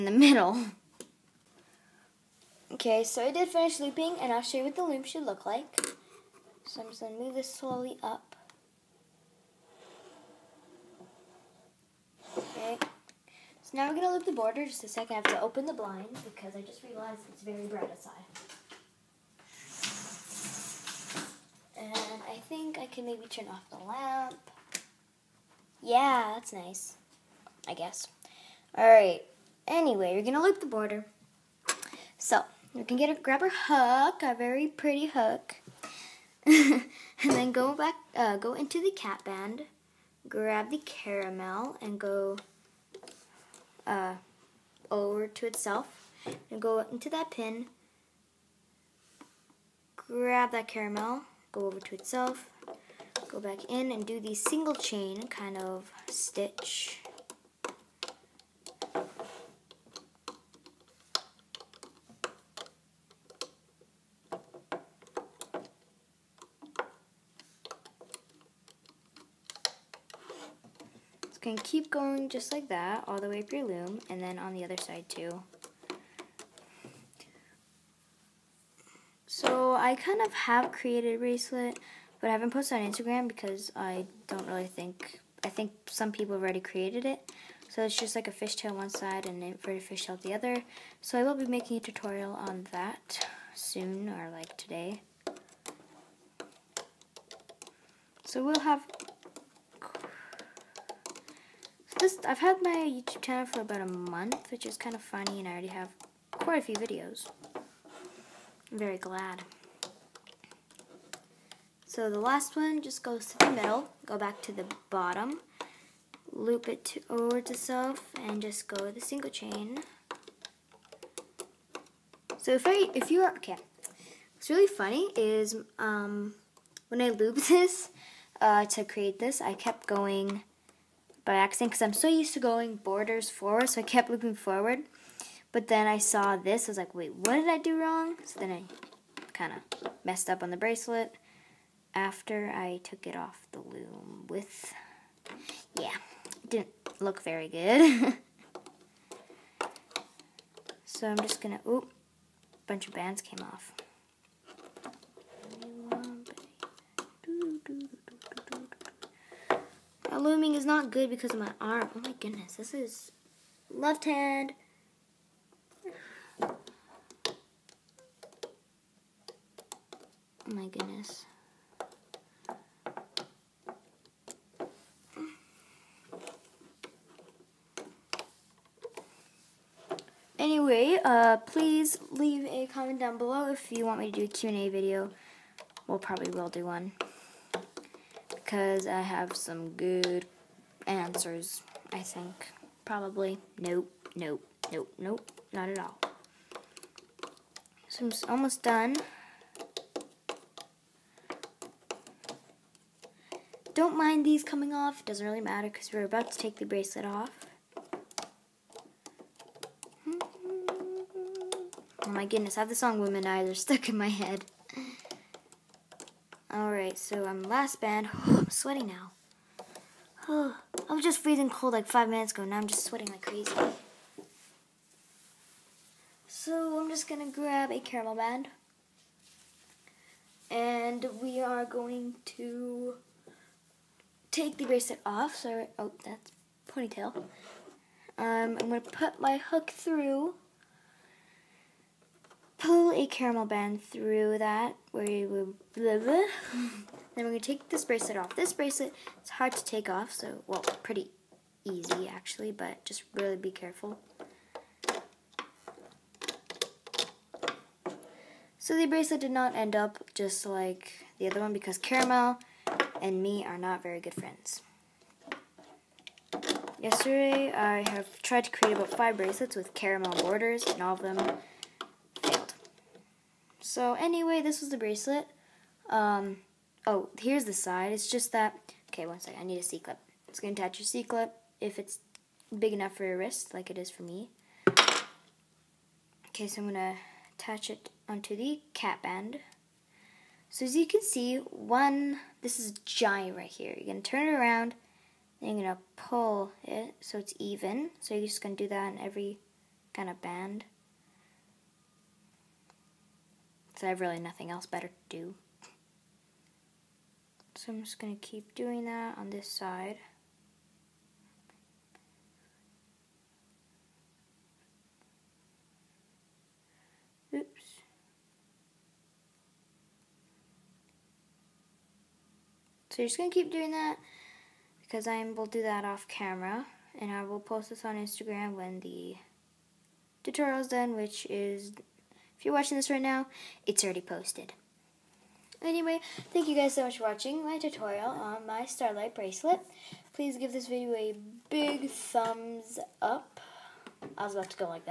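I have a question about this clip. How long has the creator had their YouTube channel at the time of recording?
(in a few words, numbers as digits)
About a month.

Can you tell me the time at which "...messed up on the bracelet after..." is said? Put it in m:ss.
2:20.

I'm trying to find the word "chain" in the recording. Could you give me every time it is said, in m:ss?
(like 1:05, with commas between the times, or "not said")
0:54, 1:59.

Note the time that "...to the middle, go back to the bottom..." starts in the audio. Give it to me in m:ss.
1:53.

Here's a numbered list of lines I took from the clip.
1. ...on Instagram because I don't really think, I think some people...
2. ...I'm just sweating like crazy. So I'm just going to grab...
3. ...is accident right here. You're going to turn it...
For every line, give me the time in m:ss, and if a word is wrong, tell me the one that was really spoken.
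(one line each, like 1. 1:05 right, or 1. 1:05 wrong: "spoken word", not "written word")
1. 1:22 right
2. 3:42 right
3. 4:52 wrong: "giant", not "accident".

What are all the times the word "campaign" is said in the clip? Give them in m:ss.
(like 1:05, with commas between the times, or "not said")
not said.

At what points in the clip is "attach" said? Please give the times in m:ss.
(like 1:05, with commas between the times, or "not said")
4:40, 4:47.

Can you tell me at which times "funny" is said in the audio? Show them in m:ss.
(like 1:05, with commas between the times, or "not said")
1:45, 2:04.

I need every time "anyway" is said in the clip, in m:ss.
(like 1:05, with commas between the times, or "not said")
0:29, 3:00, 4:33, 5:35.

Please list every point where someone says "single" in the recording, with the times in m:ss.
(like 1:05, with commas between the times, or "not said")
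0:54, 1:59.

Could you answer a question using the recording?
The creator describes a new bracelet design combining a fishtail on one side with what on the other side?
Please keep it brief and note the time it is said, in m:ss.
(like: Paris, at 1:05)
An inverted fishtail, at 1:29.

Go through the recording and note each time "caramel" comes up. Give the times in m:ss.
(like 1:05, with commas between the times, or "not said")
0:40, 0:50, 3:47, 4:03, 4:21, 4:29.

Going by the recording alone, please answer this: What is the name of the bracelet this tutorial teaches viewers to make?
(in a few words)
Starlight bracelet.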